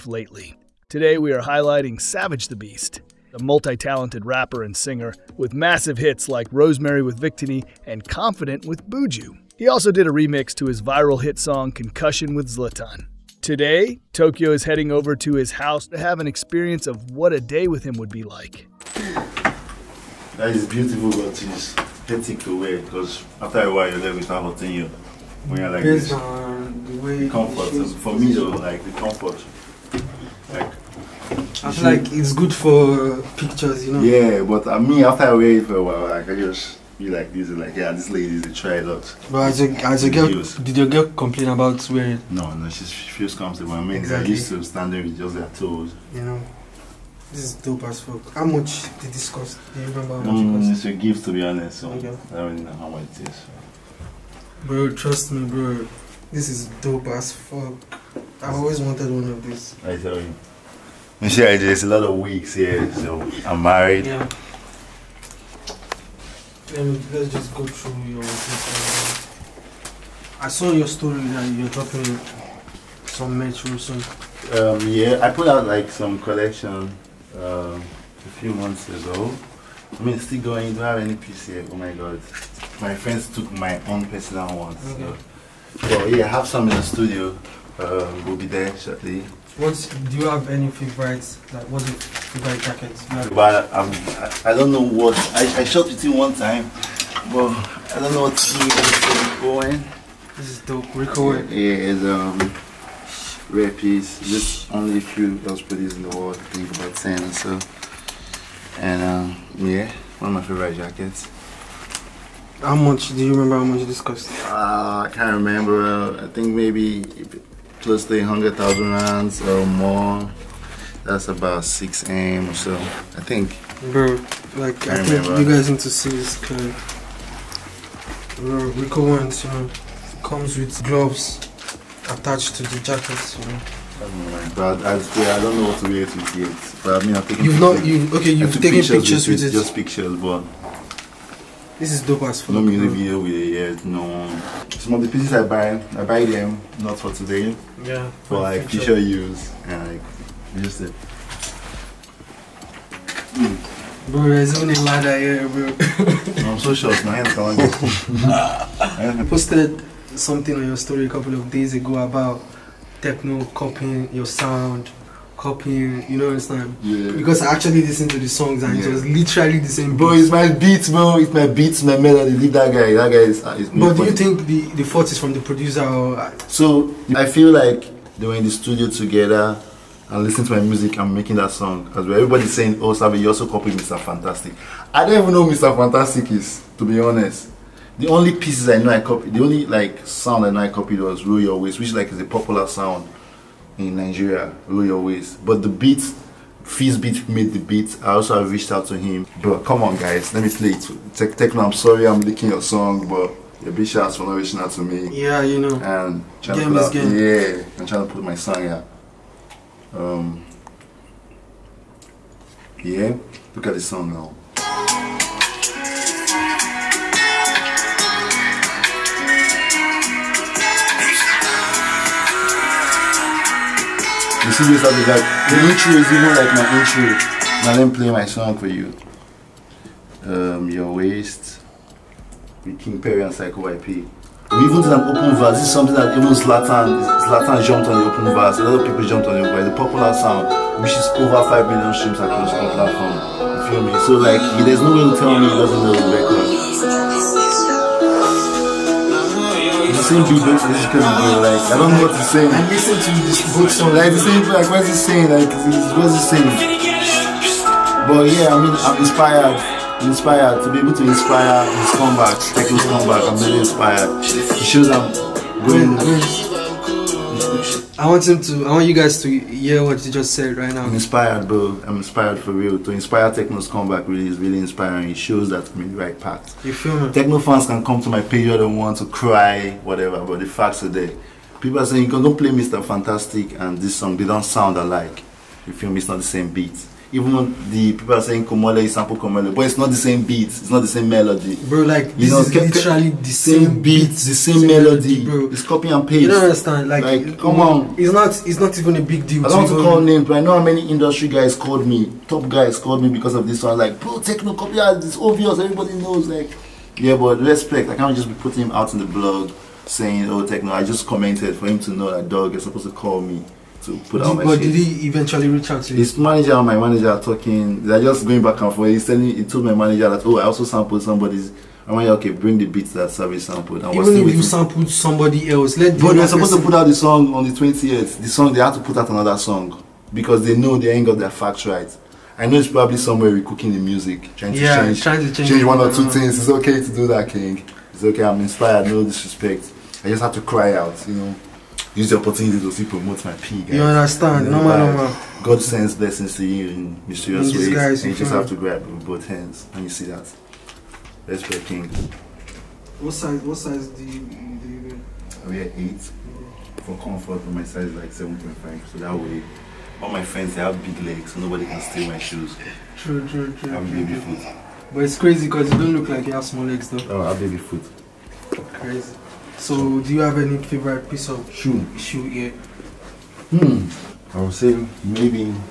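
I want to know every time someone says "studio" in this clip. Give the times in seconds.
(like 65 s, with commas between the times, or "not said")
86 s, 178 s.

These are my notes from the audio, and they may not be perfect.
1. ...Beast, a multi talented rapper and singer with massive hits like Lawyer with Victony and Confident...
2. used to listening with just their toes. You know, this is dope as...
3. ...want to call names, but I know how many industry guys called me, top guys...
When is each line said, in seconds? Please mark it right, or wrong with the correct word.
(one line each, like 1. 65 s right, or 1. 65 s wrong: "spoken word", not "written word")
1. 2 s wrong: "Rosemary", not "Lawyer"
2. 44 s wrong: "standing", not "listening"
3. 299 s right.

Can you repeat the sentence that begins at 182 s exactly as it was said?
Everybody's saying, "Oh, Savvy, you also copied Mr.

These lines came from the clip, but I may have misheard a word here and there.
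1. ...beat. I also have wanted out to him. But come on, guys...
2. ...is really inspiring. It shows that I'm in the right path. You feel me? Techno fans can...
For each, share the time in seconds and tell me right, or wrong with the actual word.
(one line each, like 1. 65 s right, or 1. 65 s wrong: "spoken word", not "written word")
1. 197 s wrong: "reached", not "wanted"
2. 274 s right.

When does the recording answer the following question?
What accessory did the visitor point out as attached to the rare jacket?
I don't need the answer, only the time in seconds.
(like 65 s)
130 s.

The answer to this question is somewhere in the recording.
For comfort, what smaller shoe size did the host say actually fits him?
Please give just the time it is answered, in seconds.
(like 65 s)
358 s.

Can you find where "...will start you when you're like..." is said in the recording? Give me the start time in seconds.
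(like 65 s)
24 s.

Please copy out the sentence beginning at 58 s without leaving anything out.
I've always wanted one of these.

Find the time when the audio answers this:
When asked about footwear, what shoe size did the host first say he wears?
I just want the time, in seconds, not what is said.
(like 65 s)
355 s.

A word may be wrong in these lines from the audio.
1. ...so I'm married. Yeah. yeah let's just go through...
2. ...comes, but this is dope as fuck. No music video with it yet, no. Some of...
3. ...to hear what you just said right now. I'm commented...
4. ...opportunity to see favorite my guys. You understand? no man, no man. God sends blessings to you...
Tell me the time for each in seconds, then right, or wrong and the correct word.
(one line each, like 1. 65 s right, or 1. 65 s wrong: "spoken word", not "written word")
1. 62 s right
2. 139 s wrong: "pictures", not "comes"
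3. 269 s wrong: "inspired", not "commented"
4. 342 s wrong: "promote", not "favorite".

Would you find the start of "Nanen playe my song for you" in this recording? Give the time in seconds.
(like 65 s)
227 s.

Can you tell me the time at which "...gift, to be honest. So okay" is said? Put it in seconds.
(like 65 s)
50 s.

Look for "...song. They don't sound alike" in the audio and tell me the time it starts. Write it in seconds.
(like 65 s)
283 s.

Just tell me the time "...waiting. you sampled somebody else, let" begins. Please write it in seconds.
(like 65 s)
324 s.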